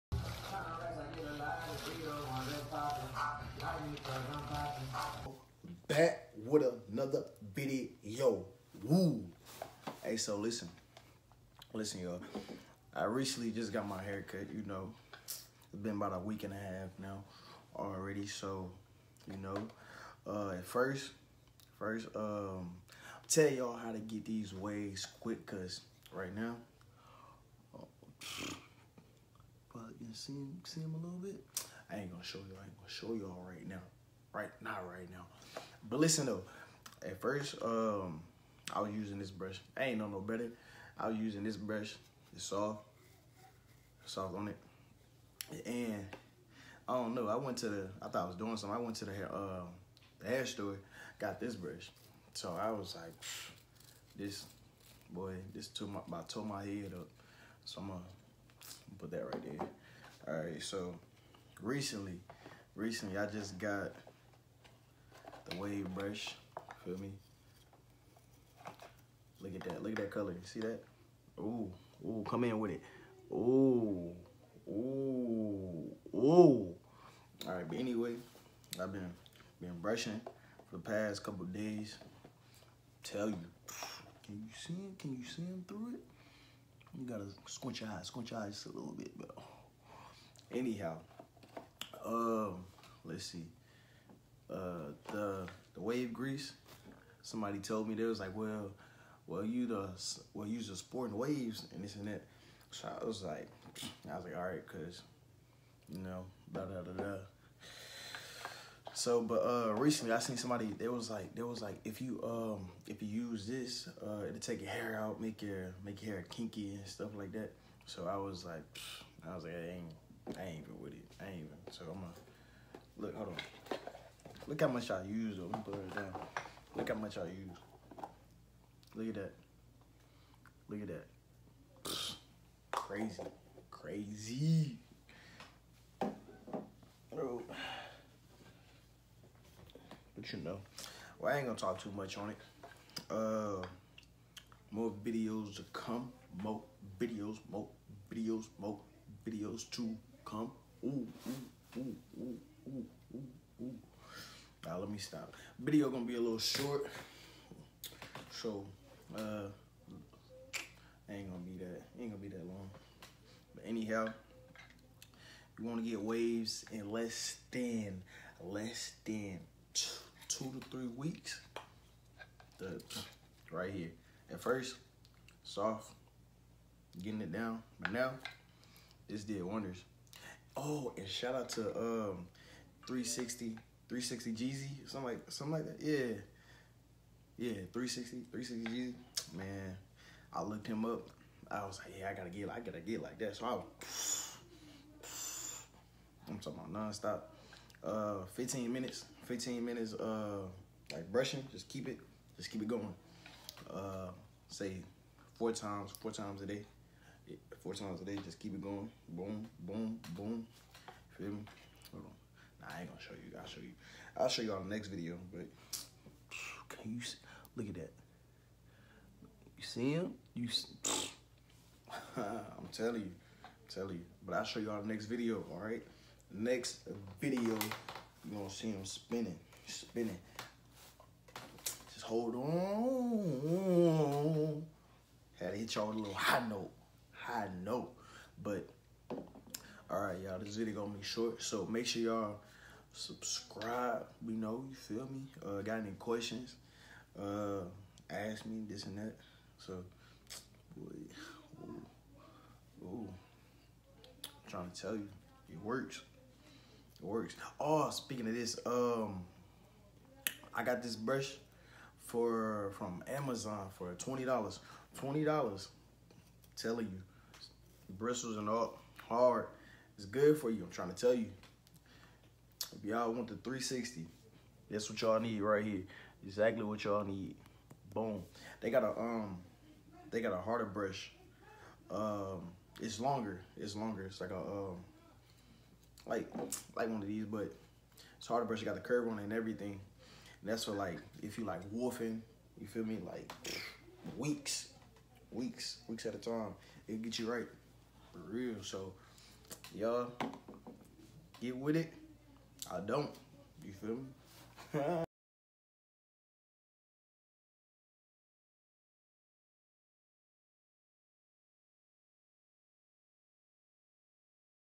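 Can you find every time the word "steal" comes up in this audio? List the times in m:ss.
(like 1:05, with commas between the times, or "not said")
not said.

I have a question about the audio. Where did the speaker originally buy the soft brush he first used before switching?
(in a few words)
the hair store.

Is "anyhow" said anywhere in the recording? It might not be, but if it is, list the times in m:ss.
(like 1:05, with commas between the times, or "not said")
1:30, 2:43.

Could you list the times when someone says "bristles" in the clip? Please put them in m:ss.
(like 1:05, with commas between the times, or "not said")
4:27.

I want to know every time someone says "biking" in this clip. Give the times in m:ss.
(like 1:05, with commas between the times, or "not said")
not said.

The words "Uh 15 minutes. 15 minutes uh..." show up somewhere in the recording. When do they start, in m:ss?
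3:17.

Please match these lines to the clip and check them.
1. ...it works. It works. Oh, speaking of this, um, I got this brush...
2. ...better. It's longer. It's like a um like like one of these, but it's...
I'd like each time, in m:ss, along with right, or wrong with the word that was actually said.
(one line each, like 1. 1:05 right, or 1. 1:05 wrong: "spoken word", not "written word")
1. 4:15 right
2. 4:42 wrong: "longer", not "better".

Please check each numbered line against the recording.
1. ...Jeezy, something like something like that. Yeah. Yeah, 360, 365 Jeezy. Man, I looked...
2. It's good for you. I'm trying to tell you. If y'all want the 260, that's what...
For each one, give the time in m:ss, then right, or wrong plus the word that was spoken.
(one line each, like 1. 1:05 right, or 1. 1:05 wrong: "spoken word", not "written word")
1. 3:04 wrong: "360", not "365"
2. 4:30 wrong: "360", not "260".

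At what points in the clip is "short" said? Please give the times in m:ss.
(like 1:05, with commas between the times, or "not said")
2:36, 4:01.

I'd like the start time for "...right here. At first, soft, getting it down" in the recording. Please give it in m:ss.
2:53.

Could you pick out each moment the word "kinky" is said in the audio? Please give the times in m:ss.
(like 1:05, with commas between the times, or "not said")
1:56.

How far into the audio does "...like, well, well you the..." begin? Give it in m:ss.
1:38.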